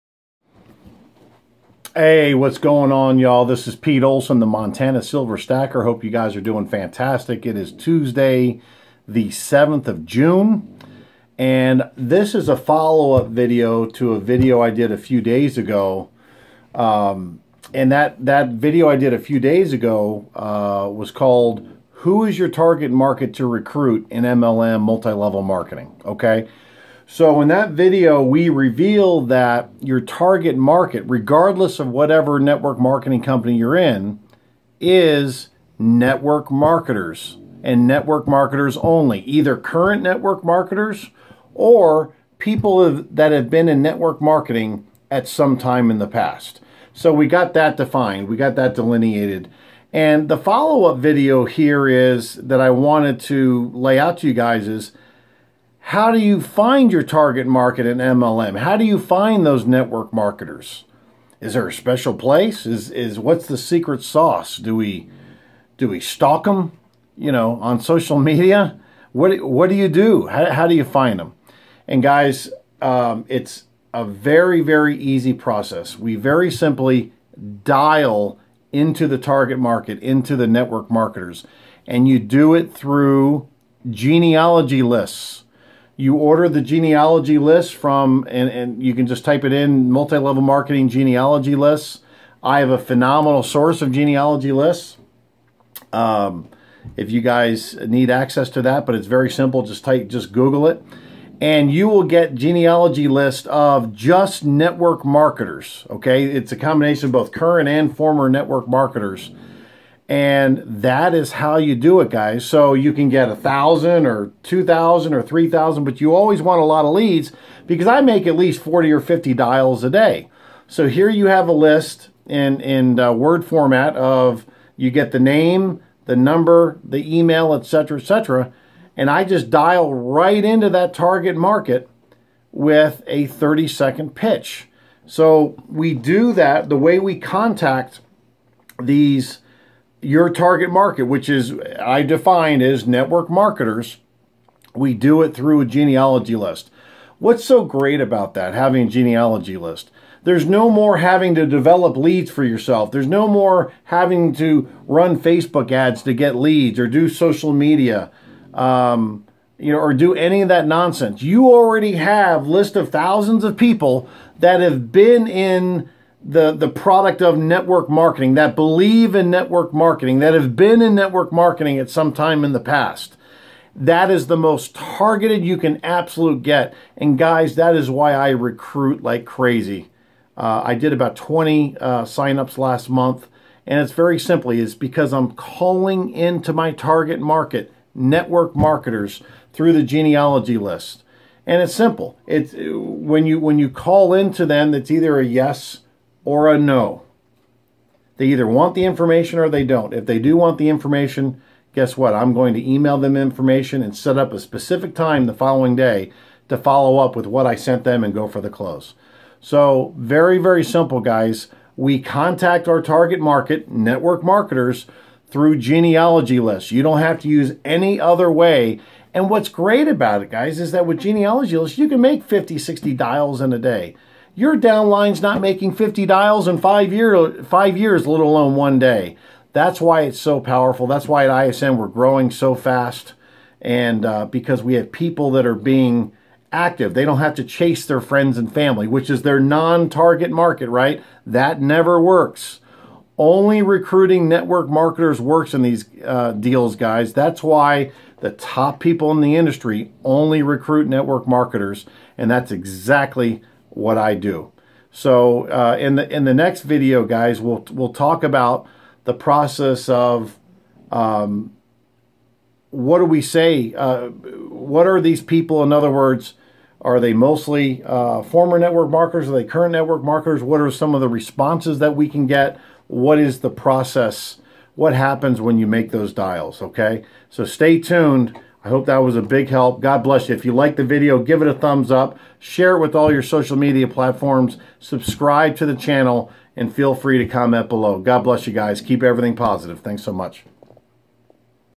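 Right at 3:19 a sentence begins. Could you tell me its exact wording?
If they do want the information, guess what?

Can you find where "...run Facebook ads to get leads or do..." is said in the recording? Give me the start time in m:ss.
2:34.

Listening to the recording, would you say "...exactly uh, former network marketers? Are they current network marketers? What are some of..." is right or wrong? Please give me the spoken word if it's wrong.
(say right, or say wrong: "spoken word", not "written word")
wrong: "mostly", not "exactly".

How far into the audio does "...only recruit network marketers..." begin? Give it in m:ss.
4:10.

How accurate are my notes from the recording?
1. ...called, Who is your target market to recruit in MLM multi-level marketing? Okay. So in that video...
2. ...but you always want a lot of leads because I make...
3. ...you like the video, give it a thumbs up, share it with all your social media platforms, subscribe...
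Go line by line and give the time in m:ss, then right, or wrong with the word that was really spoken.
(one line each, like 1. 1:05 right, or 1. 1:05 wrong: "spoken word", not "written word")
1. 0:21 right
2. 1:55 right
3. 4:40 right.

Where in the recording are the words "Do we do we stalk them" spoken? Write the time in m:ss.
1:04.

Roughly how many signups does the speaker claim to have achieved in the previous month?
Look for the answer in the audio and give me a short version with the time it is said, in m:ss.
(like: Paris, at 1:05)
20, at 3:01.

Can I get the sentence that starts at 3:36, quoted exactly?
You don't have to use any other way.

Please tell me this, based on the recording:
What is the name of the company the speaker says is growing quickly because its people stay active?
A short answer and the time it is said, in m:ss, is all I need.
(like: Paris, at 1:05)
ISN, at 3:51.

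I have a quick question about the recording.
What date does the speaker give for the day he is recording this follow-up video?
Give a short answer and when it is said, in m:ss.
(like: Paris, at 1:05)
Tuesday, June 7, at 0:07.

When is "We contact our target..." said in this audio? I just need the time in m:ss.
3:31.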